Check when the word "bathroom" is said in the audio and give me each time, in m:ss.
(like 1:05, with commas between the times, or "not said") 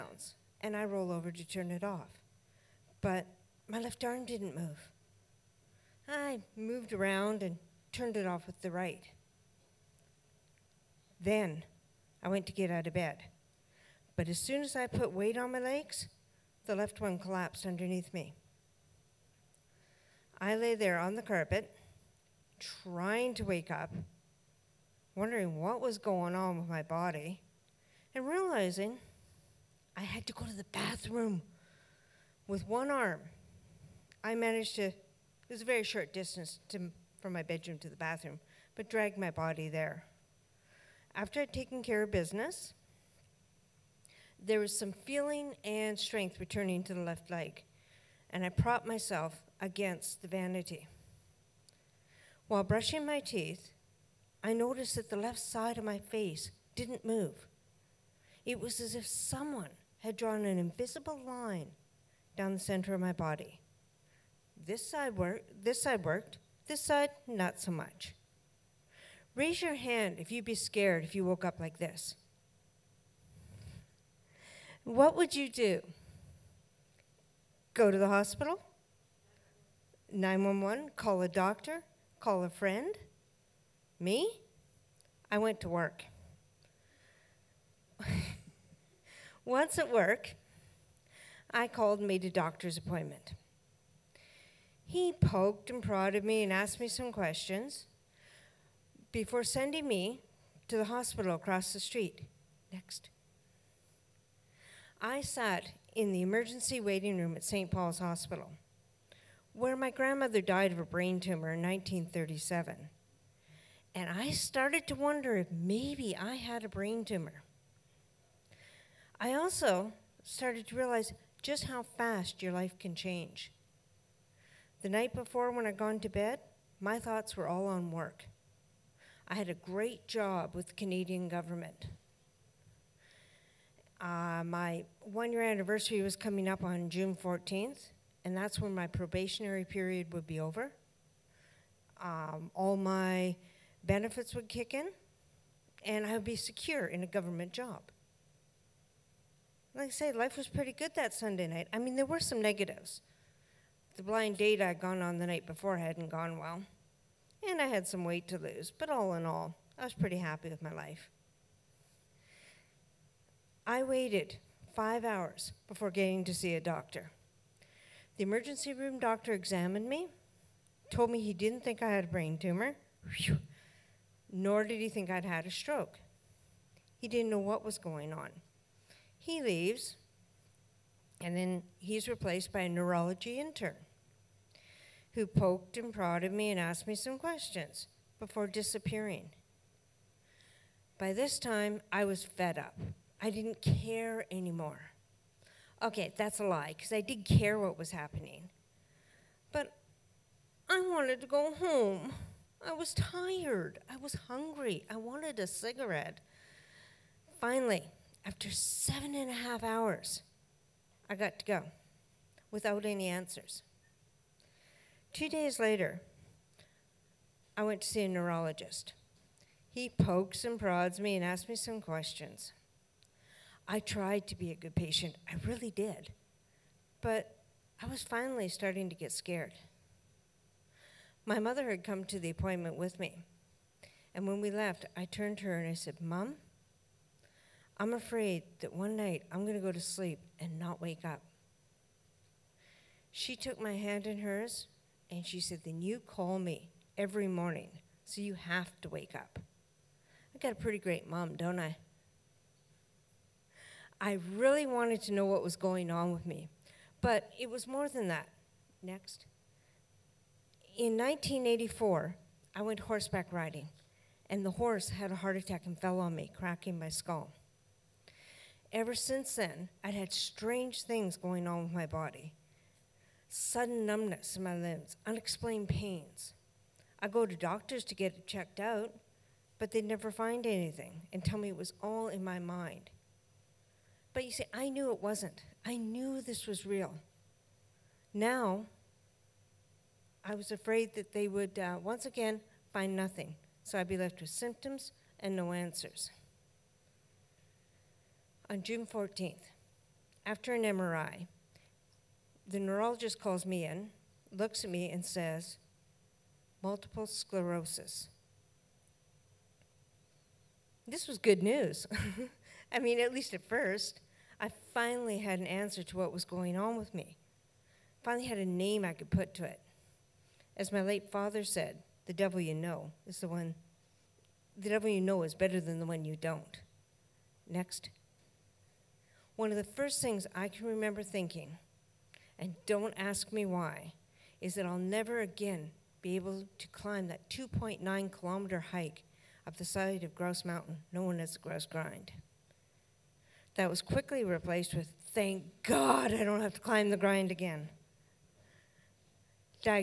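0:30, 0:37.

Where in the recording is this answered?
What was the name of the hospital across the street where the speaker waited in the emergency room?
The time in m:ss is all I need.
1:47.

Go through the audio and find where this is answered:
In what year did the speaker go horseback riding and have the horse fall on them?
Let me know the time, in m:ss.
4:20.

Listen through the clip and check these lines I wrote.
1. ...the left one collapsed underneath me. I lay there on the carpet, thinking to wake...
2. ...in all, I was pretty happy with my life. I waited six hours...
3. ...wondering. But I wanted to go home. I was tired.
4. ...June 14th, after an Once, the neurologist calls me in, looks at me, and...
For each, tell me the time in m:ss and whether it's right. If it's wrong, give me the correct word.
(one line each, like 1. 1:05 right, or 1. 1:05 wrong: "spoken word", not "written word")
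1. 0:16 wrong: "trying", not "thinking"
2. 2:39 wrong: "five", not "six"
3. 3:17 wrong: "happening", not "wondering"
4. 4:58 wrong: "MRI", not "Once".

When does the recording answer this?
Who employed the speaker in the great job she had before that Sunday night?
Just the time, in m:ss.
2:10.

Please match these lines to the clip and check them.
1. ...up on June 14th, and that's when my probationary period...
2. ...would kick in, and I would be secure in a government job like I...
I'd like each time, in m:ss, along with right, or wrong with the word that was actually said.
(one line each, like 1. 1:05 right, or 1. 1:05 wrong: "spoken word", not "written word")
1. 2:16 right
2. 2:24 right.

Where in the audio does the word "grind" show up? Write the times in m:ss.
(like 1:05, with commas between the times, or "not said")
5:41, 5:46.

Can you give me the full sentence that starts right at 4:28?
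Ever since then, I'd had strange things going on with my body sudden numbness in my limbs, unexplained pains.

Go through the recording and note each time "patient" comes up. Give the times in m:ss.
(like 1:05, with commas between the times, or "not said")
3:44.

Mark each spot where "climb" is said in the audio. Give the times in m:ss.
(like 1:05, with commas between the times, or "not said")
5:36, 5:46.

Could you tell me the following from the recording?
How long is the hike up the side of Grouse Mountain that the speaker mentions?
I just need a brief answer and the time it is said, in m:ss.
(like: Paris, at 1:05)
2.9 kilometers, at 5:37.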